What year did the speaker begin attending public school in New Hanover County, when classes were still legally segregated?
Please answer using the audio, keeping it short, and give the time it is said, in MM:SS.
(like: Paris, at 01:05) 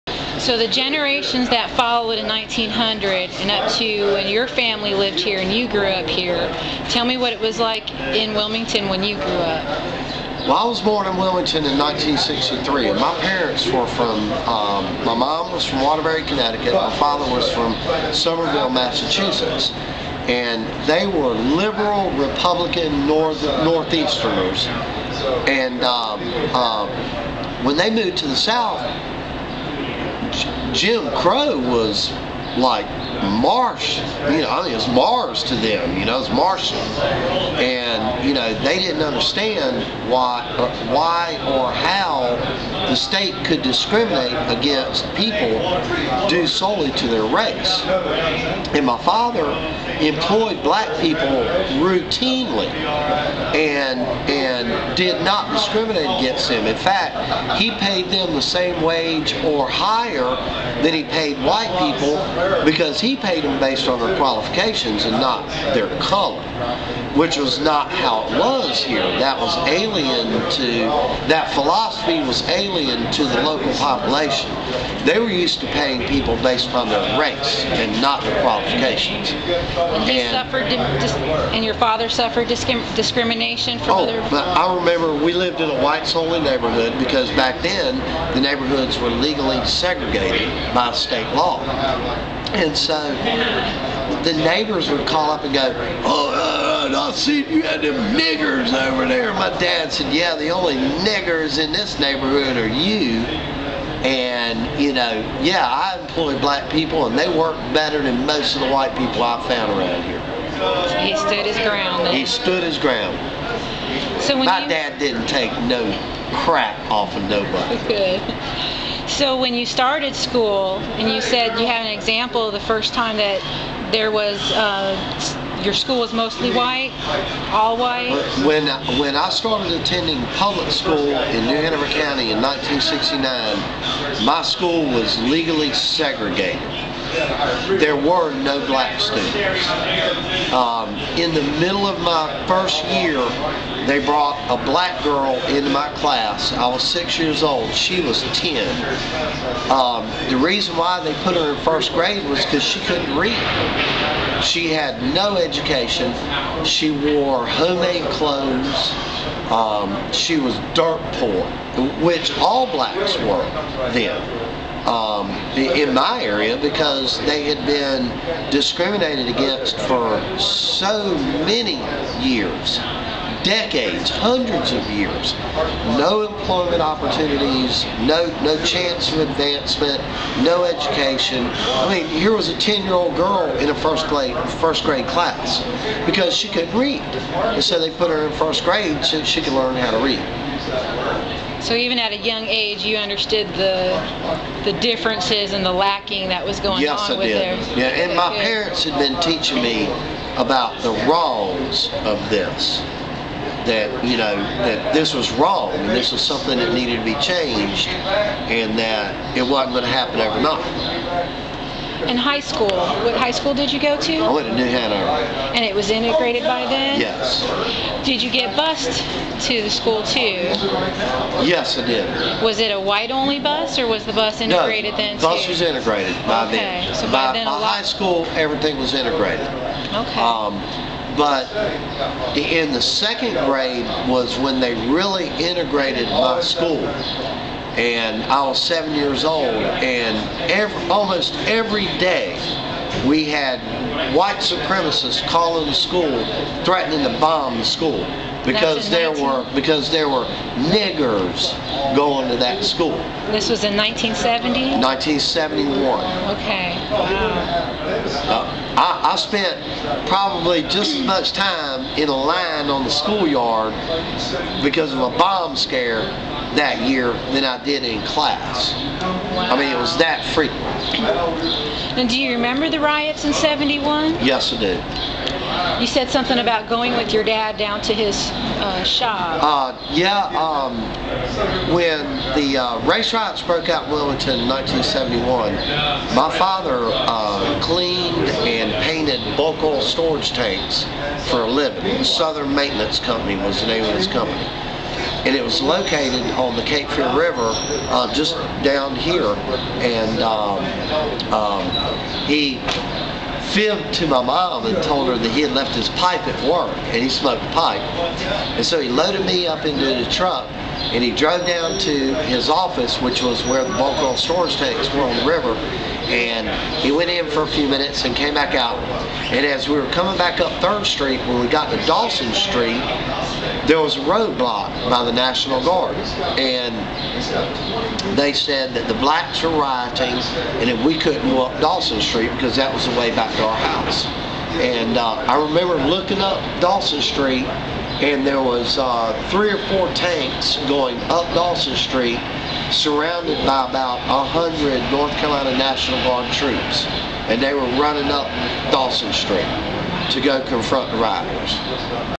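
1969, at 02:12.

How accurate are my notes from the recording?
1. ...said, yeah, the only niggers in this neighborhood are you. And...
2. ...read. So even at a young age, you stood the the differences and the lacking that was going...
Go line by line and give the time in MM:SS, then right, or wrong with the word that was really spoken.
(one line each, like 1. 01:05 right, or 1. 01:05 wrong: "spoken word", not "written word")
1. 01:39 right
2. 03:10 wrong: "understood", not "stood".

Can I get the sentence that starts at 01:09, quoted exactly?
That was alien to that philosophy was alien to the local population.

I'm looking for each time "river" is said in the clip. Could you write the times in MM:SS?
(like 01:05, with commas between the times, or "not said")
04:57, 05:15.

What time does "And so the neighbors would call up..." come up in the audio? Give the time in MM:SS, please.
01:32.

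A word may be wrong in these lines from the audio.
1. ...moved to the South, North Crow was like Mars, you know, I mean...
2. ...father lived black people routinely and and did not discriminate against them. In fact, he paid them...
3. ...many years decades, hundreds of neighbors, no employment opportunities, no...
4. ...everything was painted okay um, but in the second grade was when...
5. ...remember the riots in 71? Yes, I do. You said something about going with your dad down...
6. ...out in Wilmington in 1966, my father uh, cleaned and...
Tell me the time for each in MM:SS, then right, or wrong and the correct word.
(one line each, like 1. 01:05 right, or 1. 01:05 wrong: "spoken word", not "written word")
1. 00:27 wrong: "Jim", not "North"
2. 00:48 wrong: "employed", not "lived"
3. 02:51 wrong: "years", not "neighbors"
4. 03:48 wrong: "integrated", not "painted"
5. 04:32 right
6. 04:43 wrong: "1971", not "1966".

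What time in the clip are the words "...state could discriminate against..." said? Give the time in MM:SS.
00:42.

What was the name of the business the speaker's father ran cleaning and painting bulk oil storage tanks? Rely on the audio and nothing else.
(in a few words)
Southern Maintenance Company.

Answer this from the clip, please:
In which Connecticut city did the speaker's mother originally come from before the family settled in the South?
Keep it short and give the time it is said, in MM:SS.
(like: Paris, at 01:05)
Waterbury, at 00:15.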